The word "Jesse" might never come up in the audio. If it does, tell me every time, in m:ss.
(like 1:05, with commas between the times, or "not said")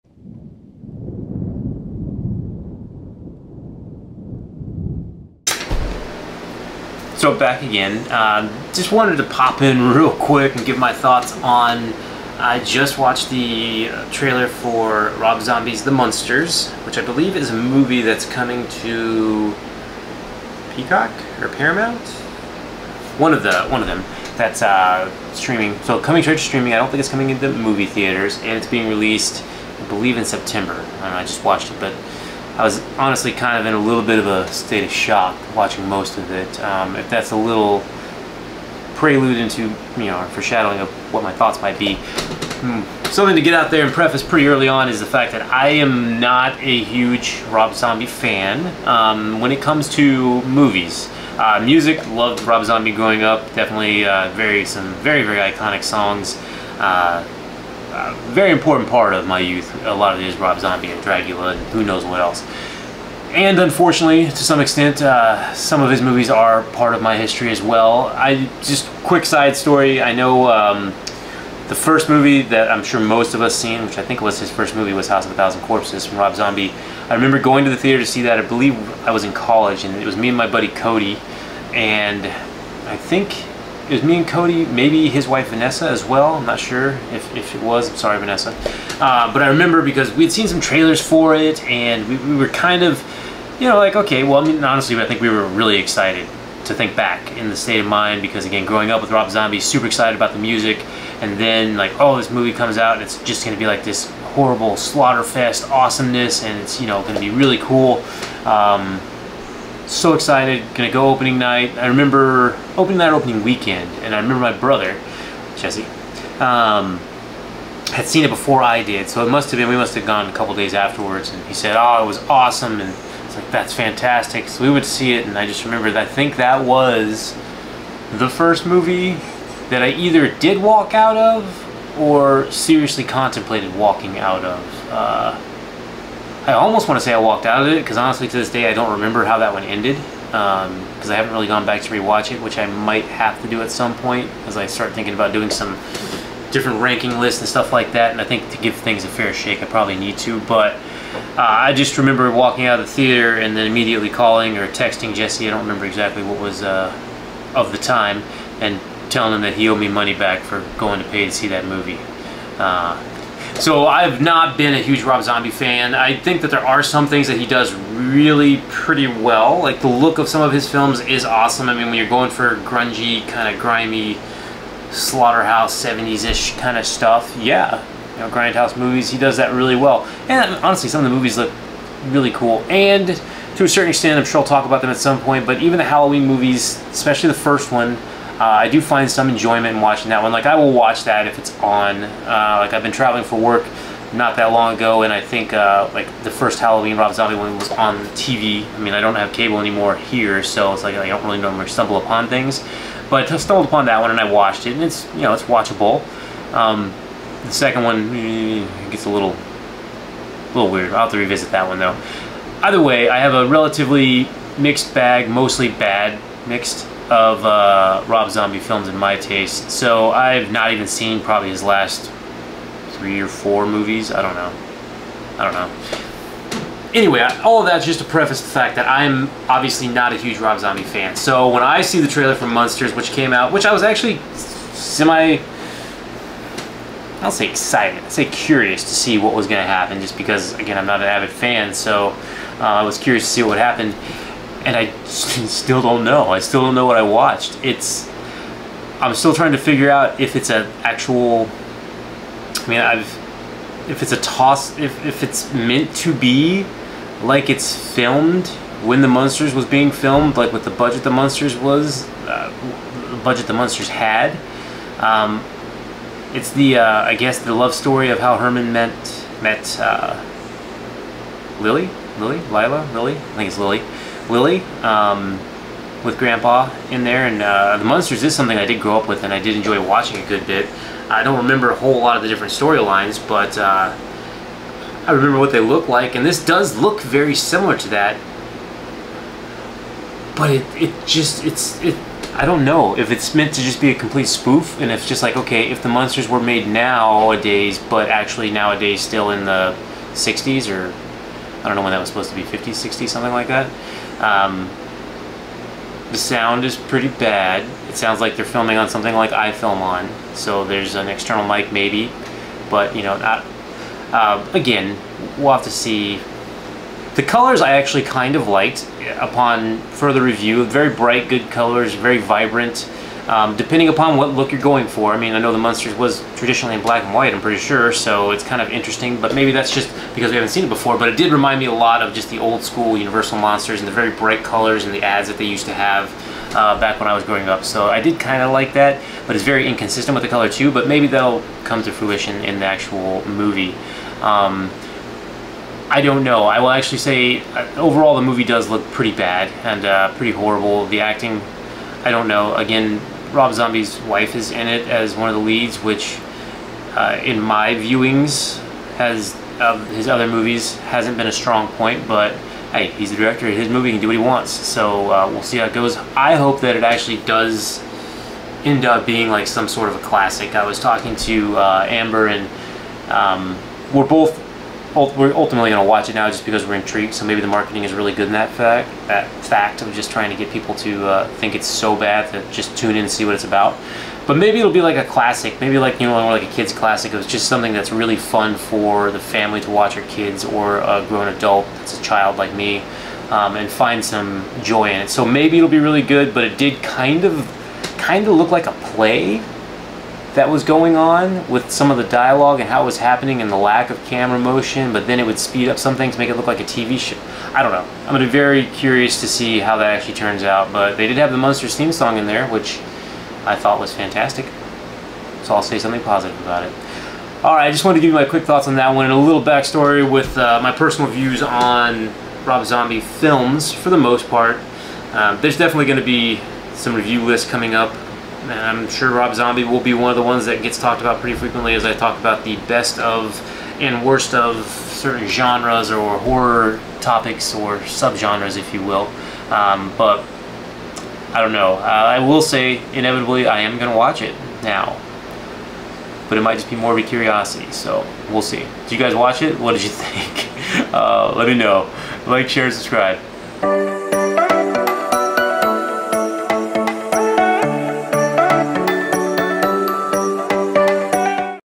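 1:55, 2:35.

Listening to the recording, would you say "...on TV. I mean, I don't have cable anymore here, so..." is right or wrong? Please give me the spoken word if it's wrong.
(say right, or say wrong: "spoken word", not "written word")
right.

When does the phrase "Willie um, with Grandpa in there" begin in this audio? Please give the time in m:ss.
4:34.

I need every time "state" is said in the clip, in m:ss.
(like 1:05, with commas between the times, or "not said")
0:34, 1:37.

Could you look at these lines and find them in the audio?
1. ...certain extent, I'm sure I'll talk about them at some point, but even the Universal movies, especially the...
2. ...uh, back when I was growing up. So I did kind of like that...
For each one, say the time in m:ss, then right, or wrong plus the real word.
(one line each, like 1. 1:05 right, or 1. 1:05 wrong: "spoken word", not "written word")
1. 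3:03 wrong: "Halloween", not "Universal"
2. 5:36 right.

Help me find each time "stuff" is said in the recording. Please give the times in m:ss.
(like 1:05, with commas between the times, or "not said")
2:27, 2:56.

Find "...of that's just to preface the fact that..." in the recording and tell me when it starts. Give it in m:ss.
3:47.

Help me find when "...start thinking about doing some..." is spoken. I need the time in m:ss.
2:24.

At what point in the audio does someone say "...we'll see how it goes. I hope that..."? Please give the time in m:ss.
6:05.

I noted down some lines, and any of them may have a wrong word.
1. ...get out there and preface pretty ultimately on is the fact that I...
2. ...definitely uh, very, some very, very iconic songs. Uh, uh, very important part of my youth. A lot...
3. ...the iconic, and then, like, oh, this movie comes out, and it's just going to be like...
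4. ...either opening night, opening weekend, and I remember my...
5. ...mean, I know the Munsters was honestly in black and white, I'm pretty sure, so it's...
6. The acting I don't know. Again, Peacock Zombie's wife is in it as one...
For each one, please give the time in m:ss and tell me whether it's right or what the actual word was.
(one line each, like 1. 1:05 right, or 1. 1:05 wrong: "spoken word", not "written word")
1. 0:43 wrong: "early", not "ultimately"
2. 0:53 right
3. 1:40 wrong: "music", not "iconic"
4. 1:51 wrong: "remember", not "either"
5. 5:25 wrong: "traditionally", not "honestly"
6. 5:50 wrong: "Rob", not "Peacock".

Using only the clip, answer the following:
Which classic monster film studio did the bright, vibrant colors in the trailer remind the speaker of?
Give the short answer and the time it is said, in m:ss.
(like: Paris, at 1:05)
Universal, at 5:32.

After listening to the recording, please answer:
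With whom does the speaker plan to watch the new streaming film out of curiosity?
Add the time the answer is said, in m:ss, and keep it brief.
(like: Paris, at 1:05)
Amber, at 6:11.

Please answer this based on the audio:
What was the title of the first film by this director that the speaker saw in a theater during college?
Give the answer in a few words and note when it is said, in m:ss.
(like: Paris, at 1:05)
House of a Thousand Corpses, at 1:15.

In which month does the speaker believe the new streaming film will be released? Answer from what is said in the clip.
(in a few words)
September.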